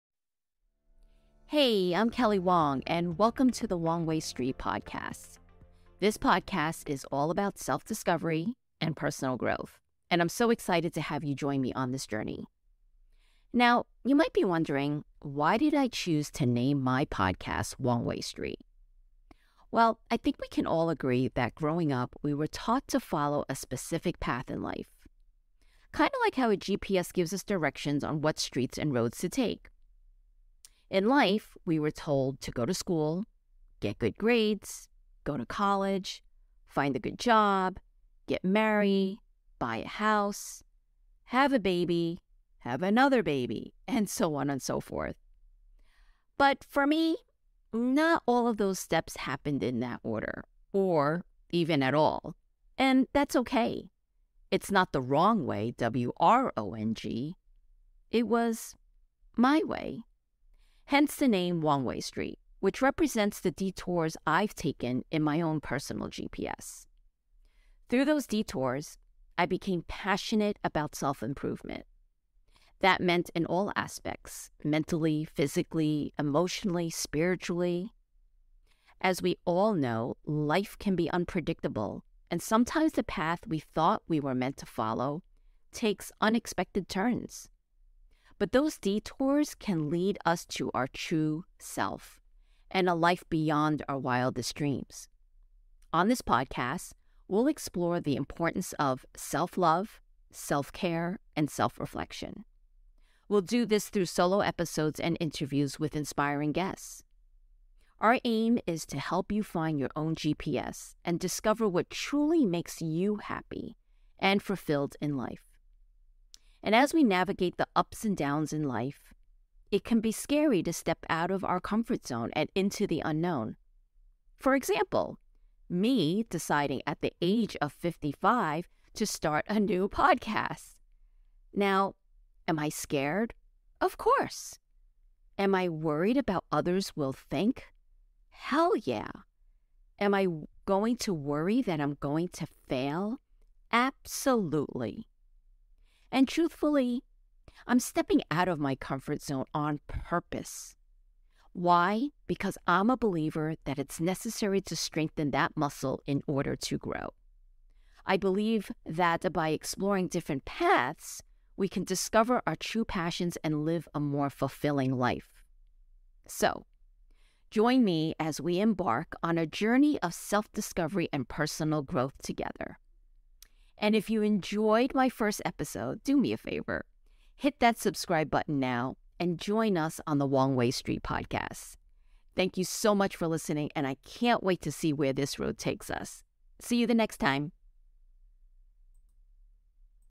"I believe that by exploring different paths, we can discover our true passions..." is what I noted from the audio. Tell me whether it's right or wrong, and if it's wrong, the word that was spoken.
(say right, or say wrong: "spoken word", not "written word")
right.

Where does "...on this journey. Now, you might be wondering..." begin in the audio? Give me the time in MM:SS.
00:11.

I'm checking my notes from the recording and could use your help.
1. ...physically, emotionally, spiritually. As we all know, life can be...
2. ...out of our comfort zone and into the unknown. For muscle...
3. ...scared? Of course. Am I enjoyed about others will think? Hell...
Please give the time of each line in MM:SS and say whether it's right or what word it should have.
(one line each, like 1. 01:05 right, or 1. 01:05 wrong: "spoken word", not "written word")
1. 01:15 right
2. 02:01 wrong: "example", not "muscle"
3. 02:12 wrong: "worried", not "enjoyed".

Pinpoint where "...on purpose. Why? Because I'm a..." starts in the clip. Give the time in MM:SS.
02:29.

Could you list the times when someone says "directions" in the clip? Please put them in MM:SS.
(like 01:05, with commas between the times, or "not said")
00:27.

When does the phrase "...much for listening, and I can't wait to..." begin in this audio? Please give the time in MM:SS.
03:02.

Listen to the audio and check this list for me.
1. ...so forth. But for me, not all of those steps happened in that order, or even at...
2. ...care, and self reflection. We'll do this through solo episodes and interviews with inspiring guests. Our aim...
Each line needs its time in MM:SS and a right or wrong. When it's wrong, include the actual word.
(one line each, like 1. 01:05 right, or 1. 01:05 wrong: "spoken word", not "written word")
1. 00:44 right
2. 01:40 right.